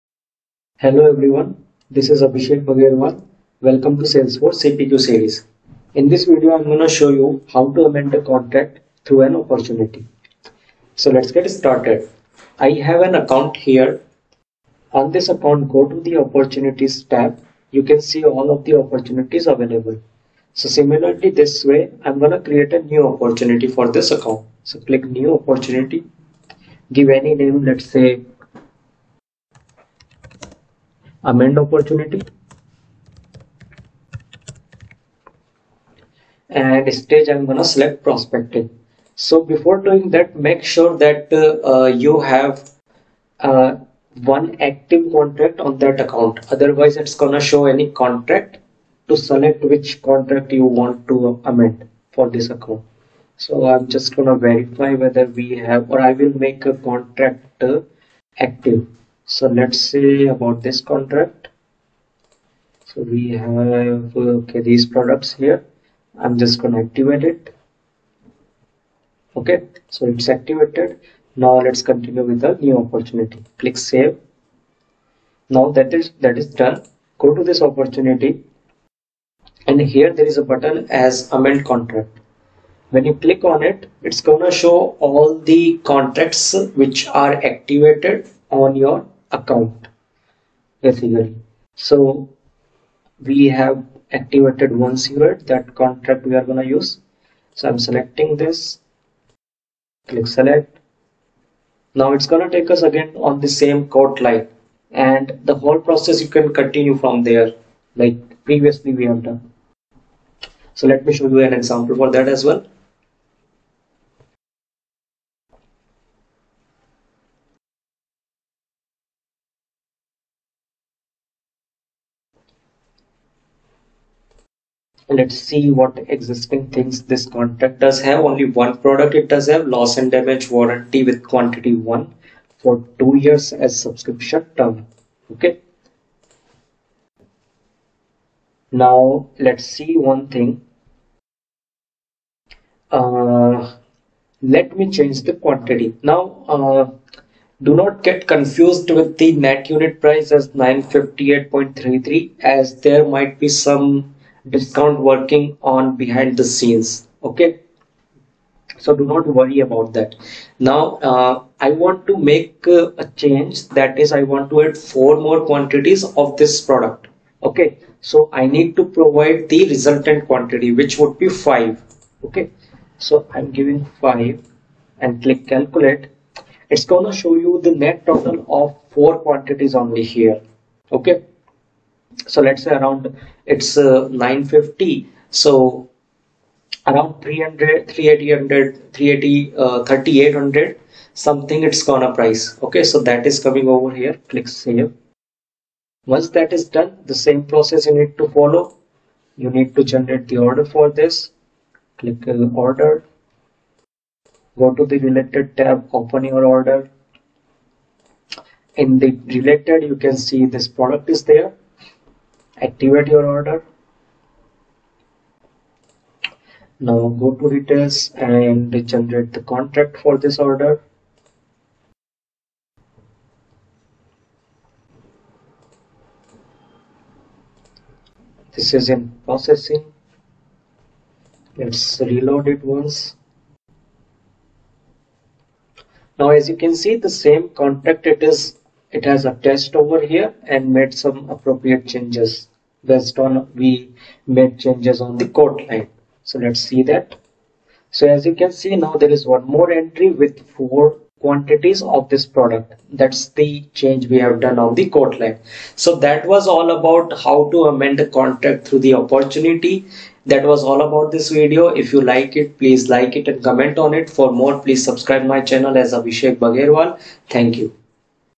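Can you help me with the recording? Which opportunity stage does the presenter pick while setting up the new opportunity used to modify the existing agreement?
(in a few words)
Prospective.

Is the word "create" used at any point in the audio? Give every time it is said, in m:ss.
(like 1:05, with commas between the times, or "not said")
0:22.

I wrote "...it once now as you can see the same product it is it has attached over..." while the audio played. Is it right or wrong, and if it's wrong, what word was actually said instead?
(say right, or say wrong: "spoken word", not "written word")
wrong: "contract", not "product".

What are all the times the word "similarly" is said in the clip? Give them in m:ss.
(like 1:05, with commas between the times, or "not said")
0:20.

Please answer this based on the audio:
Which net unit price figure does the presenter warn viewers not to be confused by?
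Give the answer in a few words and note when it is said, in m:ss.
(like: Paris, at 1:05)
958.33, at 2:30.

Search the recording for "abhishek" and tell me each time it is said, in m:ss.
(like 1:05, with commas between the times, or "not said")
0:02, 4:25.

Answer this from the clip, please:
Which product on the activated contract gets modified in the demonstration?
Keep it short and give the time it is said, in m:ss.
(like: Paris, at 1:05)
Loss and damage warranty, at 2:09.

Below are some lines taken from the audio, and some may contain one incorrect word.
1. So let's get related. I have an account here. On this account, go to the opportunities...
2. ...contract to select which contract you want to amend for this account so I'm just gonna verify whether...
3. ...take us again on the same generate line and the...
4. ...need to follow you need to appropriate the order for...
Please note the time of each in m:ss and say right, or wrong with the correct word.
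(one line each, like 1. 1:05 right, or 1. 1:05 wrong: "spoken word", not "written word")
1. 0:10 wrong: "started", not "related"
2. 0:47 right
3. 1:42 wrong: "quote", not "generate"
4. 3:17 wrong: "generate", not "appropriate".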